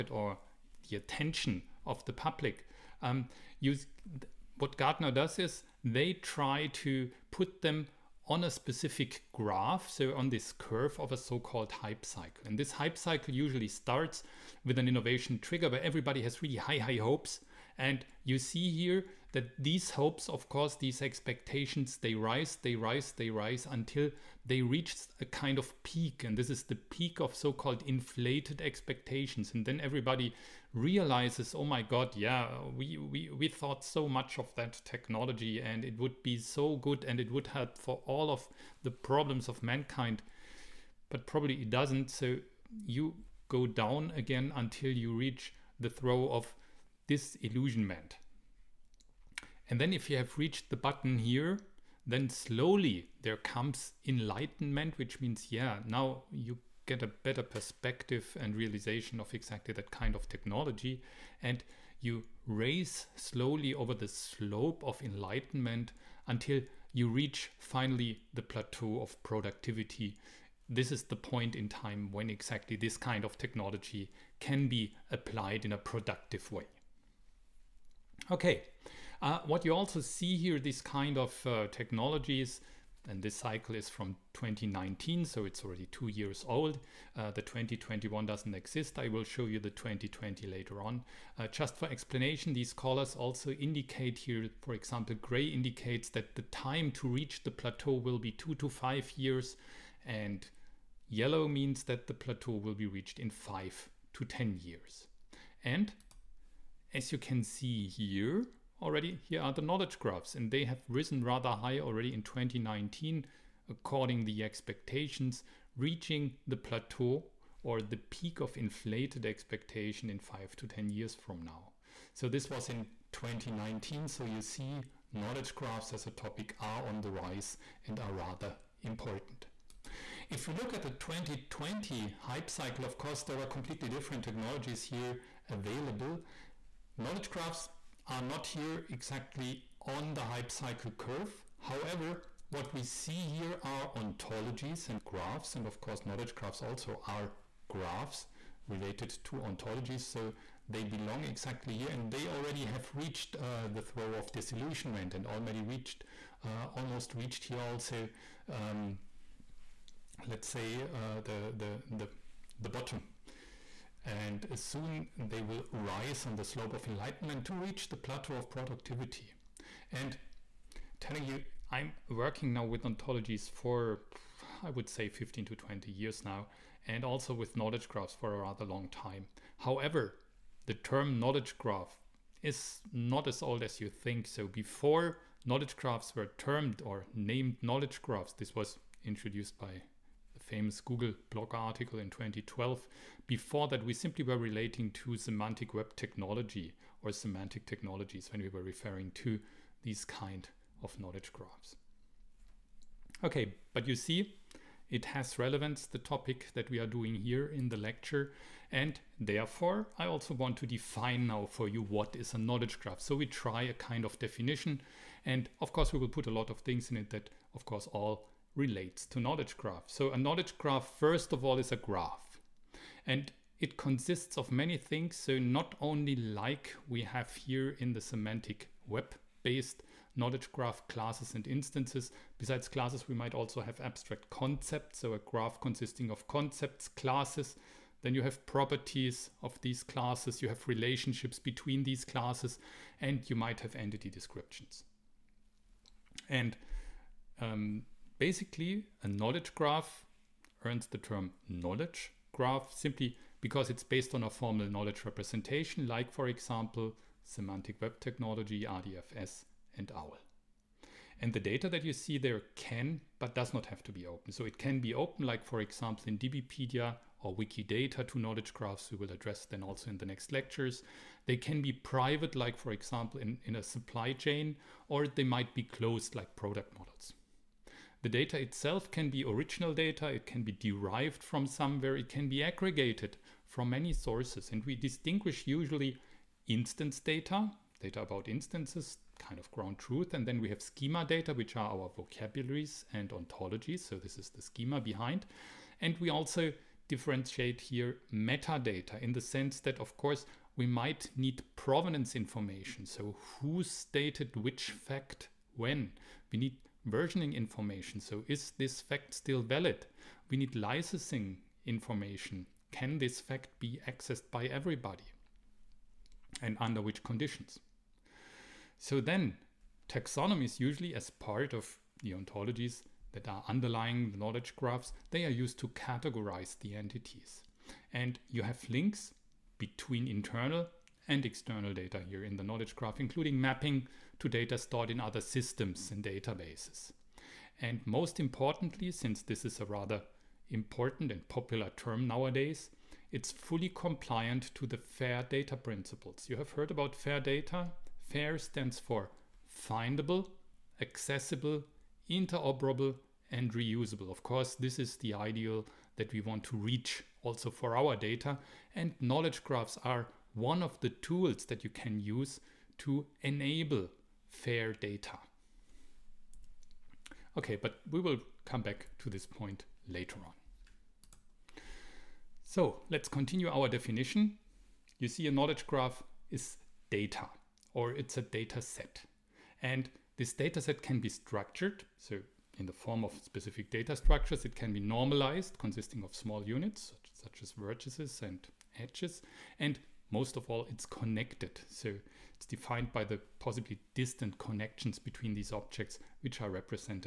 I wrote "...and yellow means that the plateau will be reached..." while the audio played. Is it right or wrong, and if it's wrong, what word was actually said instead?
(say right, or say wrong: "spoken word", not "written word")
right.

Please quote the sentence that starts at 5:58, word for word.
And knowledge graphs are one of the tools that you can use to enable fair data.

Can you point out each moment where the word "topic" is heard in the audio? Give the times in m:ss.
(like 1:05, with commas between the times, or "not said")
2:06, 3:25.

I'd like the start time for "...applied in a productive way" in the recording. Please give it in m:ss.
1:15.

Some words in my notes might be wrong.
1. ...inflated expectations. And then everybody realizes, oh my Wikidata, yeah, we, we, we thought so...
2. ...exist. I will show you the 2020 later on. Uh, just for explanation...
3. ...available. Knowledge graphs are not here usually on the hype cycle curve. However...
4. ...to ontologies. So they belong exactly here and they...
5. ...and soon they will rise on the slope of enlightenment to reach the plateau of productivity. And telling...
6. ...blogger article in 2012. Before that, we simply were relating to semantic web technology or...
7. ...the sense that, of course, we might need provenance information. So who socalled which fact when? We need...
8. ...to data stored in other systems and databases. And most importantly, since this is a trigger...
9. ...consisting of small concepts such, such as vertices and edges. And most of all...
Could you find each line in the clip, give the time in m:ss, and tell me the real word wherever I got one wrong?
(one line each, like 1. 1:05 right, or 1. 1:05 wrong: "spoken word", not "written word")
1. 0:27 wrong: "God", not "Wikidata"
2. 1:28 right
3. 2:15 wrong: "exactly", not "usually"
4. 2:29 right
5. 2:44 right
6. 3:11 right
7. 4:59 wrong: "stated", not "socalled"
8. 5:34 wrong: "rather", not "trigger"
9. 6:25 wrong: "units", not "concepts".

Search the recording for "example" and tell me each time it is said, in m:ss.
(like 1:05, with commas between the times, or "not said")
1:34, 4:16, 4:25, 4:32.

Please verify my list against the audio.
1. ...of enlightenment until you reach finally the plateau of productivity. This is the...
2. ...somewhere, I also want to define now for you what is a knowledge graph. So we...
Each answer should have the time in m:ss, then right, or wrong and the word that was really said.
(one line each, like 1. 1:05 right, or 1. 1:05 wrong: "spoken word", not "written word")
1. 1:04 right
2. 3:29 wrong: "therefore", not "somewhere".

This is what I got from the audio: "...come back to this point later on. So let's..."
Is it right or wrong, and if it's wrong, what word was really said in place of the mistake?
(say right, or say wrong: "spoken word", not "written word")
right.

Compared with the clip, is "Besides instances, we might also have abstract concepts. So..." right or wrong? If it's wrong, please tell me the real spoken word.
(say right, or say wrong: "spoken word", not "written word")
wrong: "classes", not "instances".